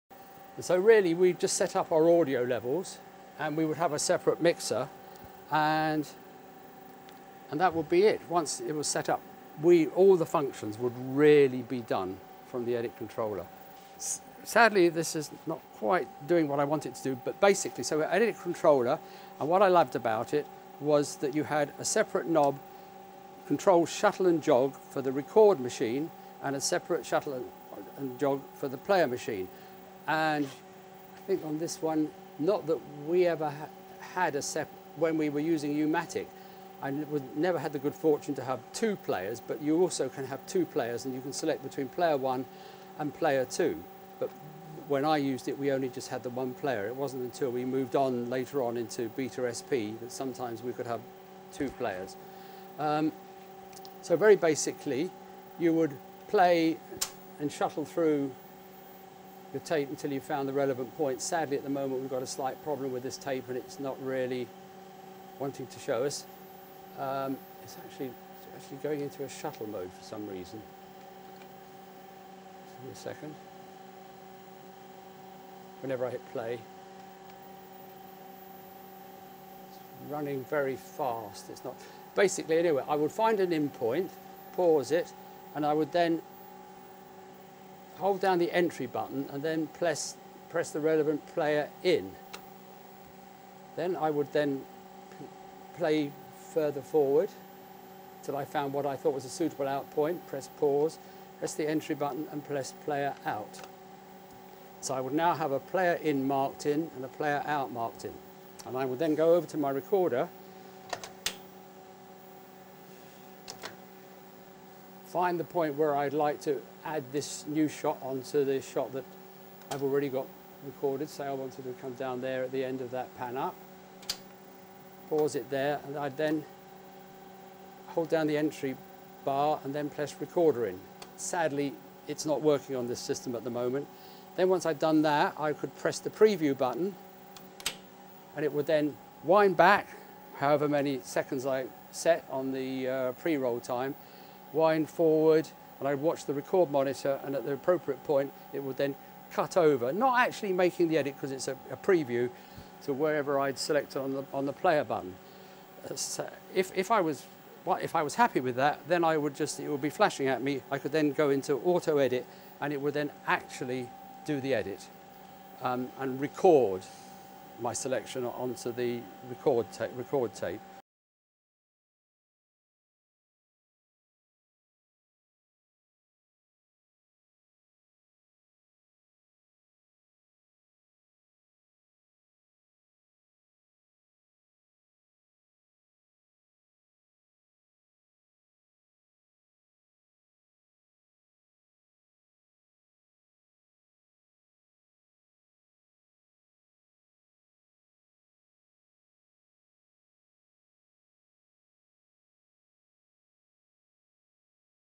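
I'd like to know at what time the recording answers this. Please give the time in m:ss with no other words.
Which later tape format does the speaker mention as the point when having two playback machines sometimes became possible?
0:49.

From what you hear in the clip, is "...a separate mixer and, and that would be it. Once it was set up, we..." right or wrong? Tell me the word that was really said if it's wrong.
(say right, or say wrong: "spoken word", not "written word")
right.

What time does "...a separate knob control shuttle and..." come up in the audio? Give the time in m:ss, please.
0:21.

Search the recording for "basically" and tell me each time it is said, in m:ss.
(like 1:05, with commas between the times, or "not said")
0:17, 0:54, 1:22.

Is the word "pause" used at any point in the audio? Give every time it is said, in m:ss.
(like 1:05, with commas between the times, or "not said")
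1:24, 1:40, 2:05.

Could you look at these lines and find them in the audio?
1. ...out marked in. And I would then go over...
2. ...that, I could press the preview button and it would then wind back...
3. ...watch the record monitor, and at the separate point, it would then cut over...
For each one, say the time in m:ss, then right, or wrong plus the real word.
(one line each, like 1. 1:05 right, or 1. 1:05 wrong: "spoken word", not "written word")
1. 1:47 right
2. 2:15 right
3. 2:25 wrong: "appropriate", not "separate".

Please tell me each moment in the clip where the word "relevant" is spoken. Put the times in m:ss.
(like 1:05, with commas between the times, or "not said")
1:00, 1:30.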